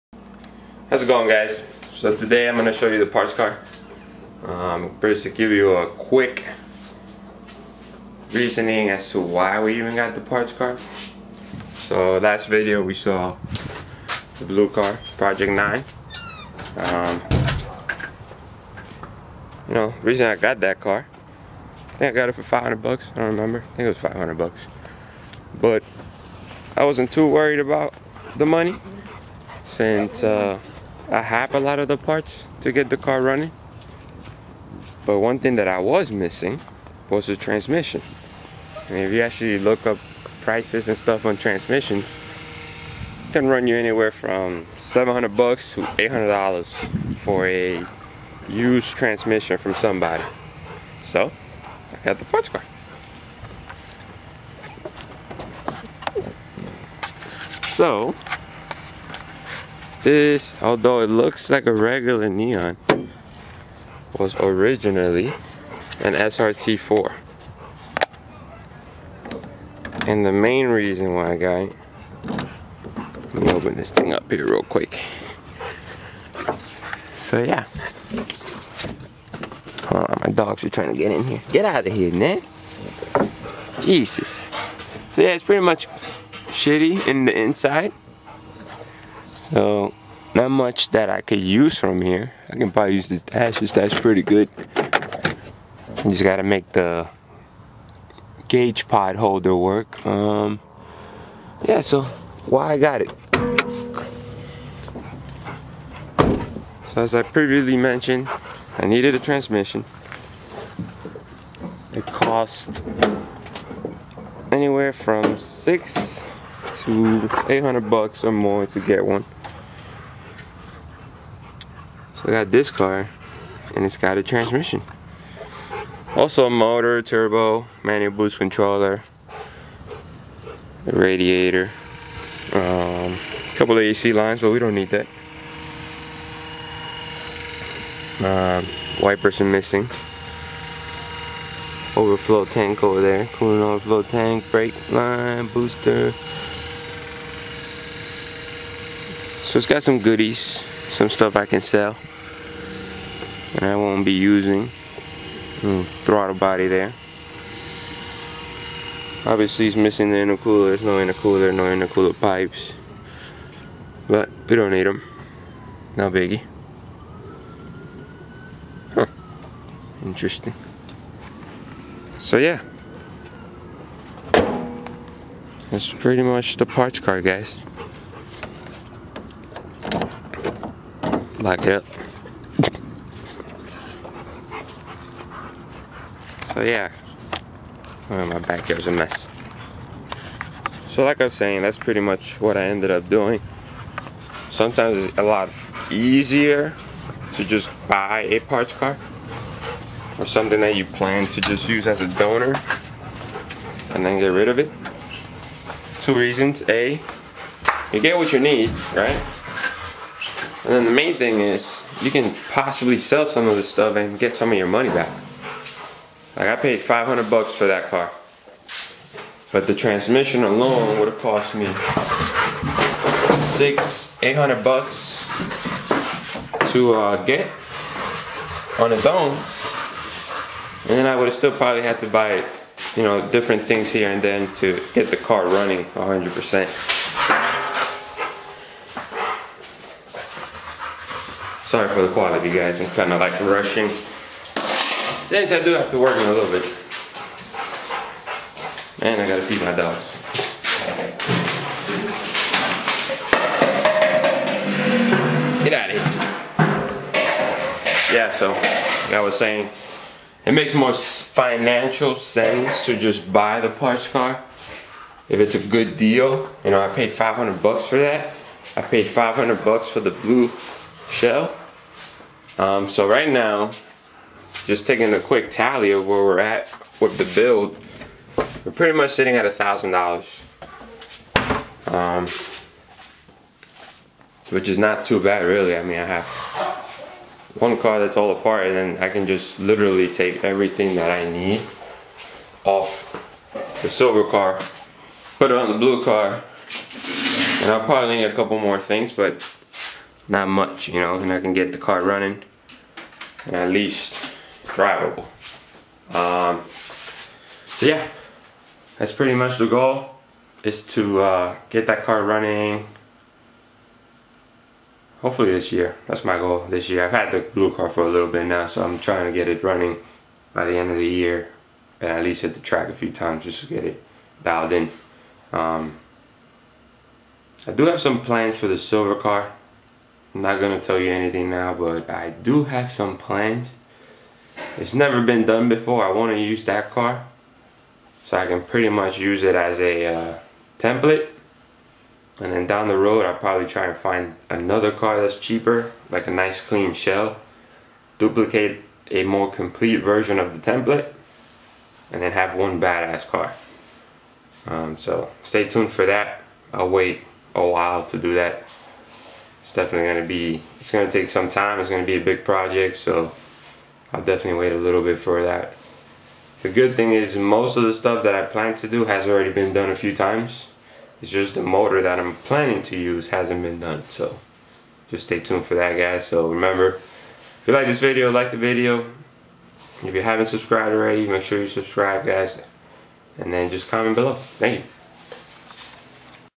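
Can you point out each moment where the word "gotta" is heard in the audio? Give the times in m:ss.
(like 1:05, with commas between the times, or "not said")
1:36, 4:09.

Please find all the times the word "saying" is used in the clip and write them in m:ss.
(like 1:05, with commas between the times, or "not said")
3:11, 4:19.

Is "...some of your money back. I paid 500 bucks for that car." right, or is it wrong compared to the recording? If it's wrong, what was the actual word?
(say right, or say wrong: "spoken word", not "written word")
right.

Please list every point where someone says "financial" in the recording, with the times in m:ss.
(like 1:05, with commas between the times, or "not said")
4:20.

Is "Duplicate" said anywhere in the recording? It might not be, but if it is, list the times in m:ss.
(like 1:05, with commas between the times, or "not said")
5:48.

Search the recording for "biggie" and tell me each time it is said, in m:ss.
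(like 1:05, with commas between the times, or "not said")
2:46.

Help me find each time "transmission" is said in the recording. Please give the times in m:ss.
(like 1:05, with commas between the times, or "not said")
0:37, 0:41, 0:48, 1:49, 2:04, 3:39.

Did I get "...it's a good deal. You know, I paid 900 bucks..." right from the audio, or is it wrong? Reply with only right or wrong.
wrong.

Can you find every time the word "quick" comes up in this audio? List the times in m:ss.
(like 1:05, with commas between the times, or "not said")
0:05, 1:14, 4:35.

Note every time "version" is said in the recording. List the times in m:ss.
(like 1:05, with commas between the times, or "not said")
5:49.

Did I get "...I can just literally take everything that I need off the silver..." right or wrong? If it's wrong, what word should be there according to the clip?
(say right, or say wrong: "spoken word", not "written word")
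right.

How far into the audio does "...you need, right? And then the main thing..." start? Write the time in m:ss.
3:28.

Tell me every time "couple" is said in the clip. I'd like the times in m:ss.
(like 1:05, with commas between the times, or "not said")
2:13, 4:58.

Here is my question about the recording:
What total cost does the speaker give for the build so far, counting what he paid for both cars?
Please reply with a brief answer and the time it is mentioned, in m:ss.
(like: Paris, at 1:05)
$1,000, at 4:39.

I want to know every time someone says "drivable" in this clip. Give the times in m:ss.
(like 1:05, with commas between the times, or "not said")
5:04.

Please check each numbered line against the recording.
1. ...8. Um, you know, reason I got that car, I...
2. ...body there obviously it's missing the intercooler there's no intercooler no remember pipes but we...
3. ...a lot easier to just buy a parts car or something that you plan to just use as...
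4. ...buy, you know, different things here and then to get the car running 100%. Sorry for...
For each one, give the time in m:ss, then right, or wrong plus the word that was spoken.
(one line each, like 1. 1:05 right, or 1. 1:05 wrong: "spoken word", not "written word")
1. 0:15 wrong: "9", not "8"
2. 2:36 wrong: "intercooler", not "remember"
3. 3:15 right
4. 3:52 right.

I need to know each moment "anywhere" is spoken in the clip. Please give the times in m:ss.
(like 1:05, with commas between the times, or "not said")
0:43, 1:54.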